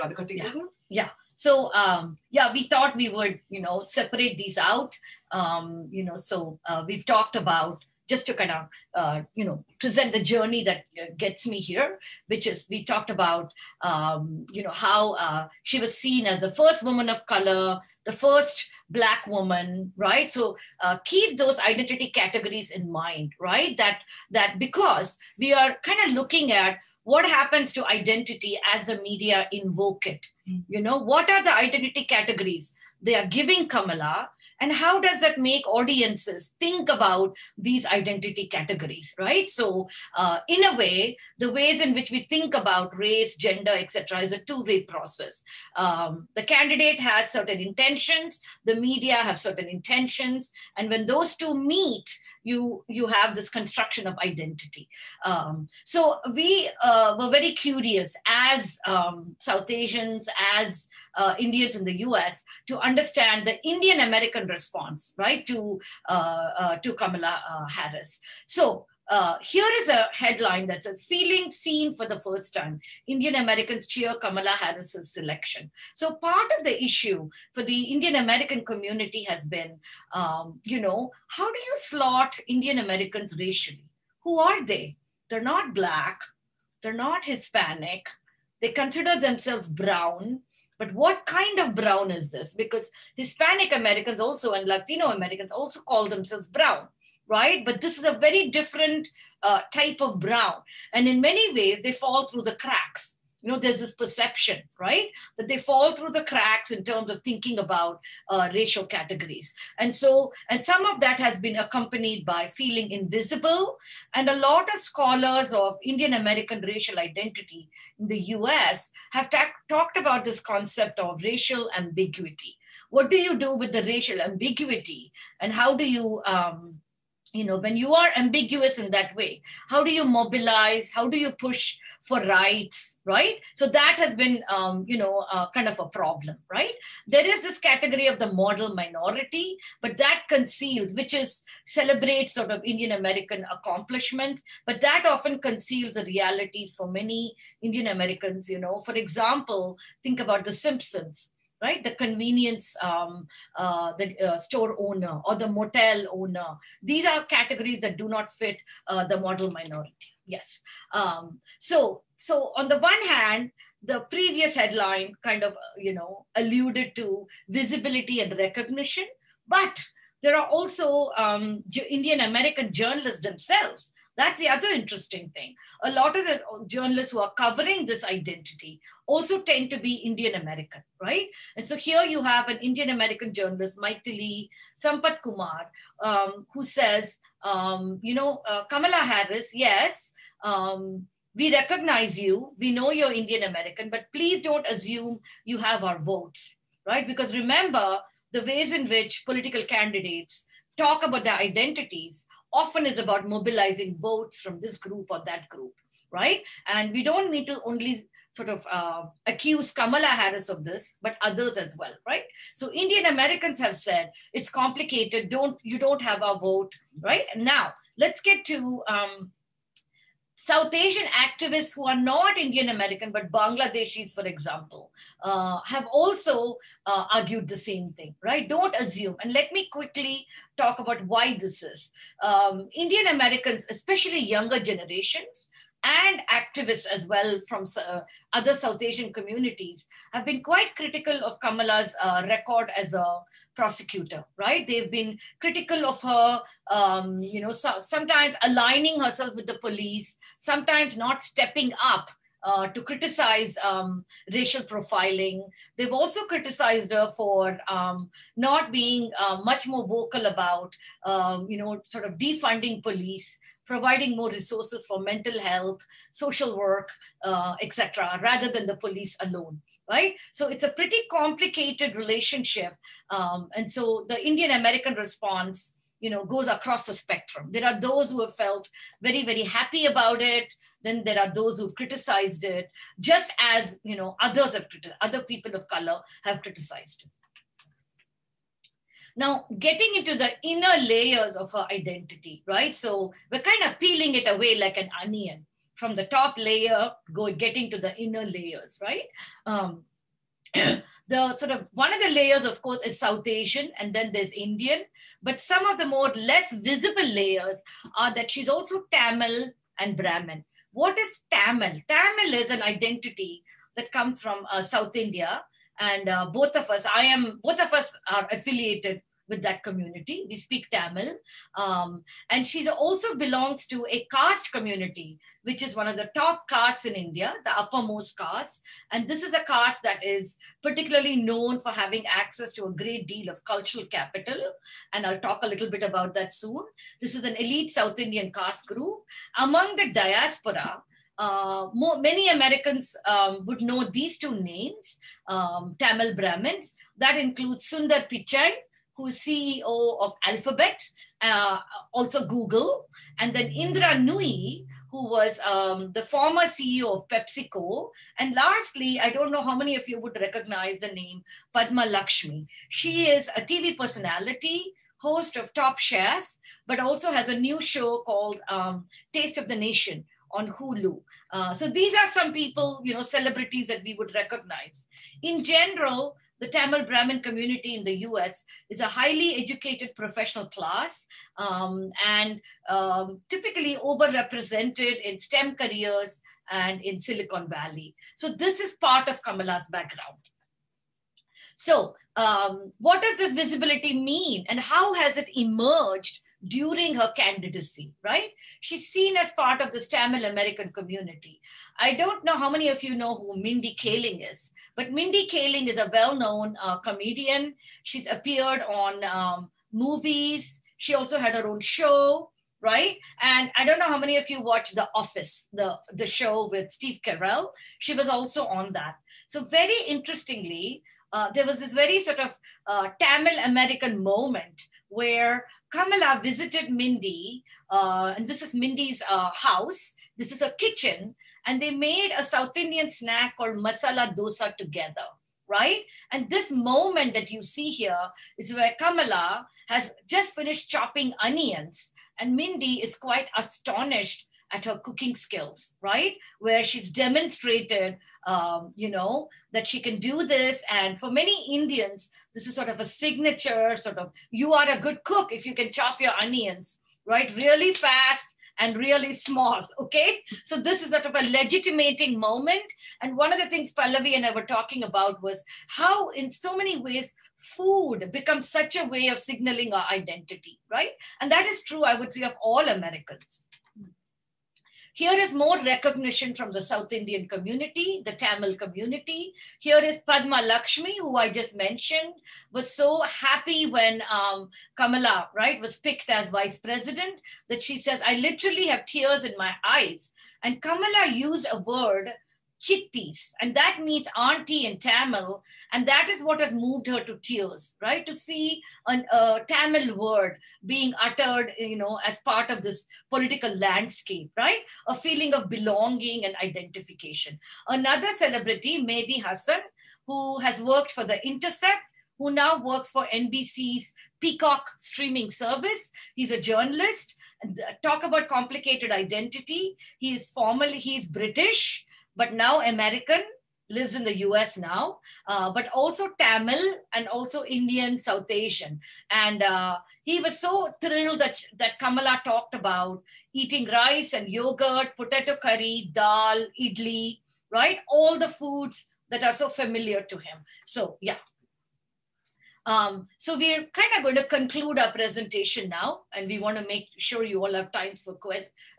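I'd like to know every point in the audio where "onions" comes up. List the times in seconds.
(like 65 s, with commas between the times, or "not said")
295 s, 441 s, 456 s.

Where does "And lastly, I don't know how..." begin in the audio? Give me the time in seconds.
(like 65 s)
358 s.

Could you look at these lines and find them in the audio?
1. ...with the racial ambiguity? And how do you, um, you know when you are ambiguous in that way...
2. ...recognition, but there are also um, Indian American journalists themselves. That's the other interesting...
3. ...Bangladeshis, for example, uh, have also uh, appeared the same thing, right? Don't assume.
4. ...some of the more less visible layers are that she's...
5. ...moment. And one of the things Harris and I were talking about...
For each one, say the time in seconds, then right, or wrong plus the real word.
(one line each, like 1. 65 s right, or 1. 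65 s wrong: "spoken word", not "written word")
1. 123 s right
2. 168 s right
3. 223 s wrong: "argued", not "appeared"
4. 305 s right
5. 462 s wrong: "Pallavi", not "Harris".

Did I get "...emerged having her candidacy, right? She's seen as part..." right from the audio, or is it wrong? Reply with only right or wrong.
wrong.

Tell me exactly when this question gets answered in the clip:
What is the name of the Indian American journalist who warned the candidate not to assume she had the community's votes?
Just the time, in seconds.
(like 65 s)
183 s.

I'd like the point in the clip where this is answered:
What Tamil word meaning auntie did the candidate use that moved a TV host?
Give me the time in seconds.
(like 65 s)
492 s.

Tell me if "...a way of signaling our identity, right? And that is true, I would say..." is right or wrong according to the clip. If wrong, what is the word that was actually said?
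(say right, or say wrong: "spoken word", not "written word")
right.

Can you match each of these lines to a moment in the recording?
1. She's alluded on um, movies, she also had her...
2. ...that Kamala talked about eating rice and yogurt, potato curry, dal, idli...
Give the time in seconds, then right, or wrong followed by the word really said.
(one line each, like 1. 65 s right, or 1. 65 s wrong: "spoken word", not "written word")
1. 407 s wrong: "appeared", not "alluded"
2. 531 s right.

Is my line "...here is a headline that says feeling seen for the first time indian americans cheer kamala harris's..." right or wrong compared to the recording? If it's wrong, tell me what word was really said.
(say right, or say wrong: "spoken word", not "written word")
right.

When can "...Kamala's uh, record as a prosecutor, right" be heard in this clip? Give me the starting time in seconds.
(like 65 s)
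241 s.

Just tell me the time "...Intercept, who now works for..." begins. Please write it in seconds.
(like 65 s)
511 s.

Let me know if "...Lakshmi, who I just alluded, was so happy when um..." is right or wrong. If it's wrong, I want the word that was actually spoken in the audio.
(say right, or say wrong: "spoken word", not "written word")
wrong: "mentioned", not "alluded".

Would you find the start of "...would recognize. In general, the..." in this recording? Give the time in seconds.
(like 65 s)
373 s.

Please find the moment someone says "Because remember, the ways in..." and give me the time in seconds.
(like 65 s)
197 s.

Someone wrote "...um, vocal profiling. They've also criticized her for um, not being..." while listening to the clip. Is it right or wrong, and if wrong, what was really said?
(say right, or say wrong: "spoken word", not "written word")
wrong: "racial", not "vocal".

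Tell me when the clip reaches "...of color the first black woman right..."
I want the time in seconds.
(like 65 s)
17 s.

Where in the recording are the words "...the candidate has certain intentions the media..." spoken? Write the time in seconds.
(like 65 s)
46 s.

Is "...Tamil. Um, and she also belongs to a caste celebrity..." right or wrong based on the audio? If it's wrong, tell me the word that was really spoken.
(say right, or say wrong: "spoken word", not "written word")
wrong: "community", not "celebrity".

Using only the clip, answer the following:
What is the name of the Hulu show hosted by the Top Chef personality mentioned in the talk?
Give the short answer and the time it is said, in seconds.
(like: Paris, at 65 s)
Taste of the Nation, at 369 s.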